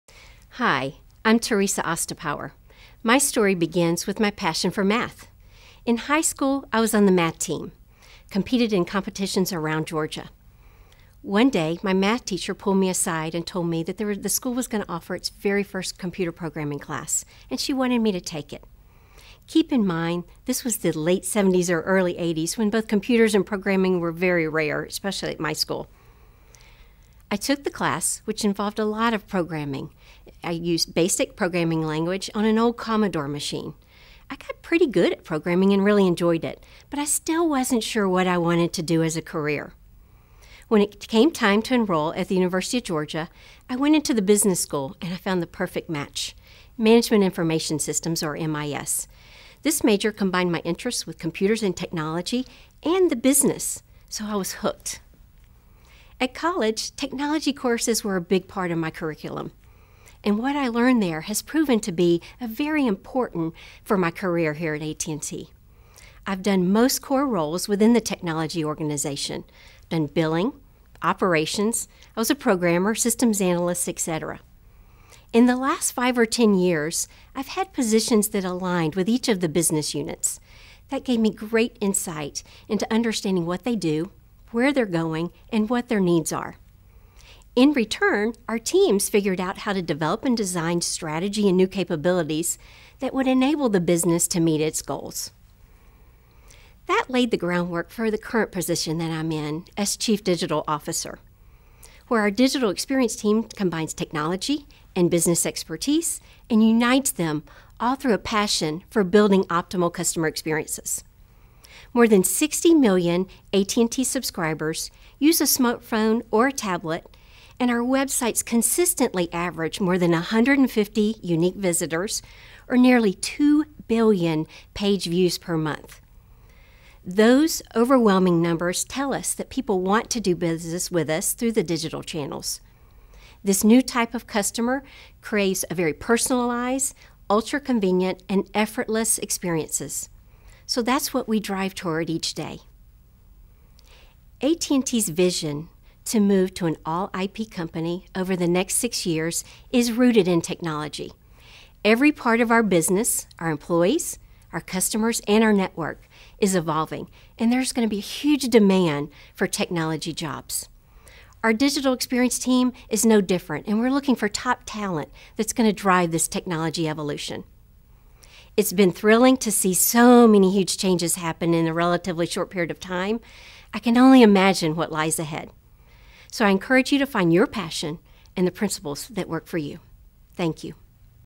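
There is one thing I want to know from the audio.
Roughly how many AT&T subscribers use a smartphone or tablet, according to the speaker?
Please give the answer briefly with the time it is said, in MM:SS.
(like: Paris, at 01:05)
more than 60 million, at 01:51.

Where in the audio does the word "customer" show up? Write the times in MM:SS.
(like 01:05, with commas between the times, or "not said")
01:49, 02:14, 02:34.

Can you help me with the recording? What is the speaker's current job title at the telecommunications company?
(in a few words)
Chief Digital Officer.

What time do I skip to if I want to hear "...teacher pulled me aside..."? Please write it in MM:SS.
00:12.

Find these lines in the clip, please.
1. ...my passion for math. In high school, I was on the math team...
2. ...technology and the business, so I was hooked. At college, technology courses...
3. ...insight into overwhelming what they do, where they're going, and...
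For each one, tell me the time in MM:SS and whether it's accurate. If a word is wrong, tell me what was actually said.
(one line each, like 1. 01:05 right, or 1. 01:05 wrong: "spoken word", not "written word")
1. 00:04 right
2. 00:51 right
3. 01:21 wrong: "understanding", not "overwhelming".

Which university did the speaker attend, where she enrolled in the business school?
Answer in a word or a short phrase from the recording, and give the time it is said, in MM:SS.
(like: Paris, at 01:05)
University of Georgia, at 00:42.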